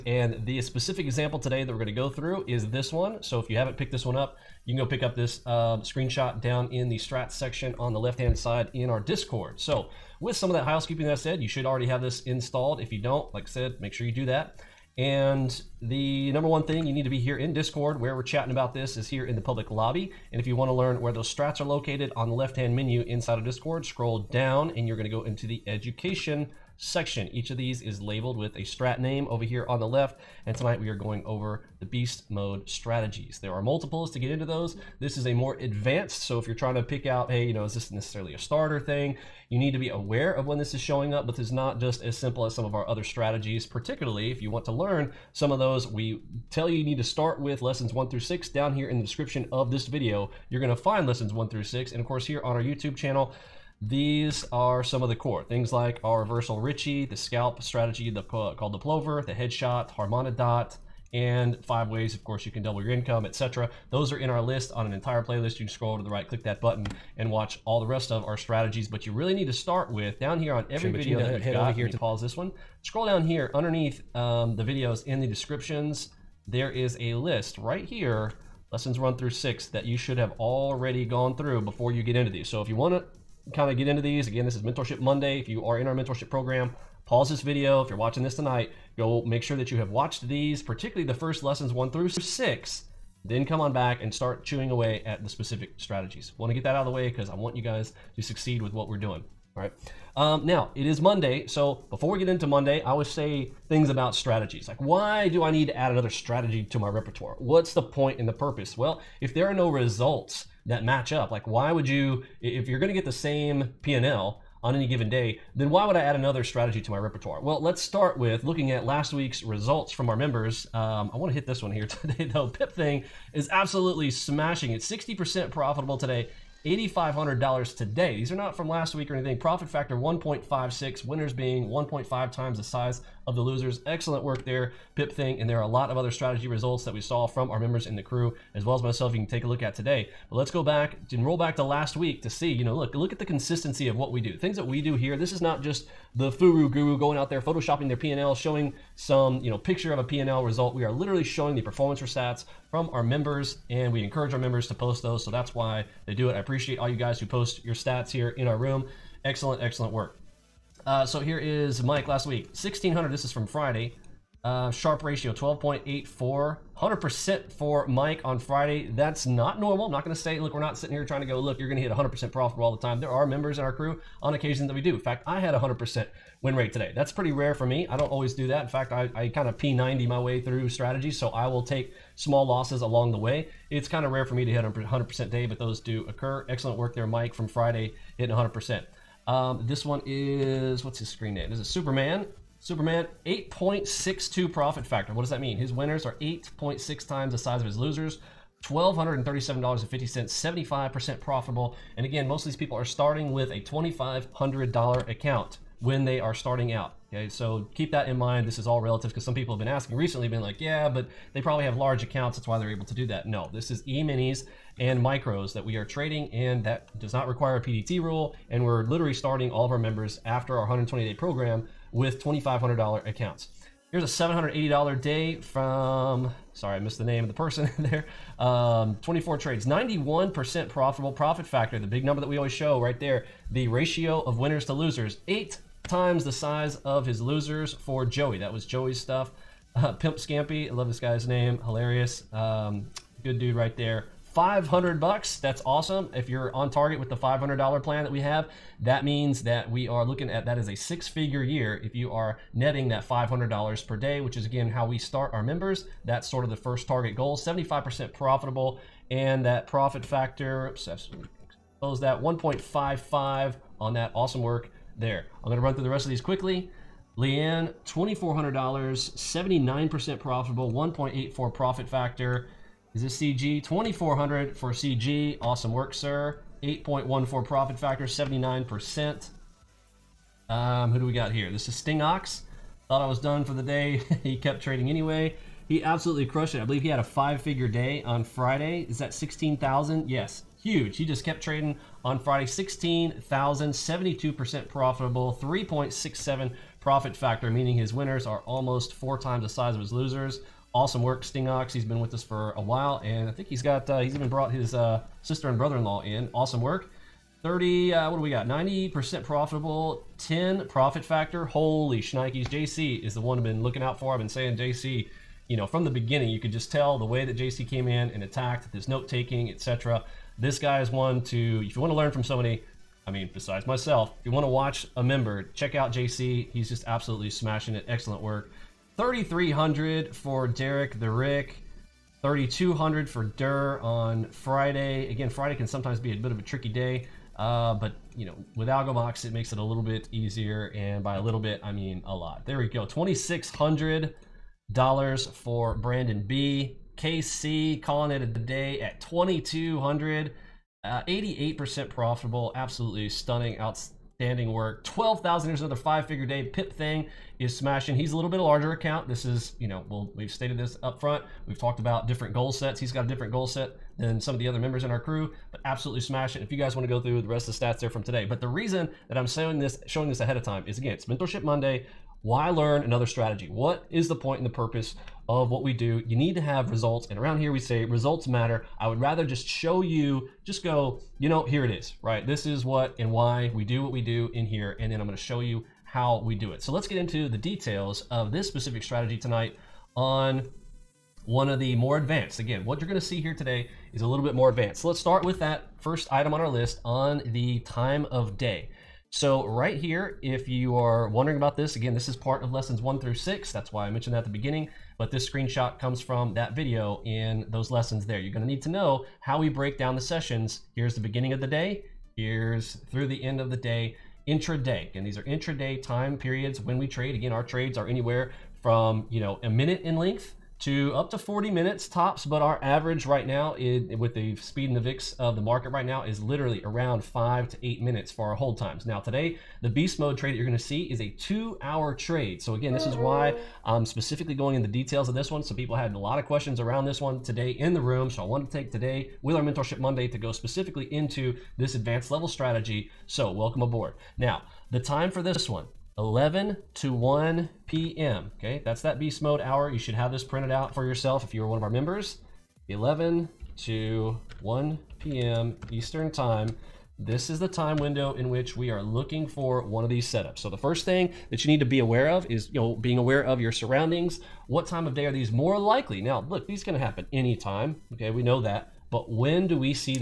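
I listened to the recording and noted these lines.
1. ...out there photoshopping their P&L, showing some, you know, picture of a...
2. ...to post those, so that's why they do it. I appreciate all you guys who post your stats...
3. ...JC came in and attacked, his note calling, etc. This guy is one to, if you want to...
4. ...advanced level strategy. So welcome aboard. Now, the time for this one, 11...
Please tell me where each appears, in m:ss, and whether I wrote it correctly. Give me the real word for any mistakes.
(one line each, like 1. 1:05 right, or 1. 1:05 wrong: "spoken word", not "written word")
1. 2:27 right
2. 2:34 right
3. 5:17 wrong: "taking", not "calling"
4. 7:21 right.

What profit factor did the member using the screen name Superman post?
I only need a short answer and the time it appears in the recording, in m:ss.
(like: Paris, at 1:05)
8.62, at 3:13.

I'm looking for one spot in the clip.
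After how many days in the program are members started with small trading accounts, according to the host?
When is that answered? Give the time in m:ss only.
3:40.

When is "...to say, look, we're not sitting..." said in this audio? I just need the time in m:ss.
2:50.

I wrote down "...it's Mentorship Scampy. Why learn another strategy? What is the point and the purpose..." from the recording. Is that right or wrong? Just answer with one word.
wrong.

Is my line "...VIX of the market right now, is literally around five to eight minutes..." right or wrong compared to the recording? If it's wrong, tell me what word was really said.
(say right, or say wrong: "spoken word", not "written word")
right.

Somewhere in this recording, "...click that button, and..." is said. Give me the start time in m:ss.
1:06.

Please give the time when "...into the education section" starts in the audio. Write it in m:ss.
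0:25.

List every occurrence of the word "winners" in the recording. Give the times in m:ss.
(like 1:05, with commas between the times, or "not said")
2:11, 3:15, 3:54, 4:57.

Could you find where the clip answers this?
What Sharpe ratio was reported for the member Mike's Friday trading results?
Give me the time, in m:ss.
2:45.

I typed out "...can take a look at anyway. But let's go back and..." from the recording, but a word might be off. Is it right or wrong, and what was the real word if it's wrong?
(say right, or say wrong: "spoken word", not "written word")
wrong: "today", not "anyway".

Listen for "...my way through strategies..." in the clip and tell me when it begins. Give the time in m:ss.
3:00.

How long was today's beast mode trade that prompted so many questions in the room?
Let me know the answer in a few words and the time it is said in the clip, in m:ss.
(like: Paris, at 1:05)
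two hour, at 7:11.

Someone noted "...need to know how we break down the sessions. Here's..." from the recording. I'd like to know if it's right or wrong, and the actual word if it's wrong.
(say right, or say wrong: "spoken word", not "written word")
right.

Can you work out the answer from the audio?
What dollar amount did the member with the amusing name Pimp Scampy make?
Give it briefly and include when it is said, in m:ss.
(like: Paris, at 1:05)
500, at 4:04.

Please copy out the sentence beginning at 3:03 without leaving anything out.
It's kind of rare for me to hit 100% day, but those do occur.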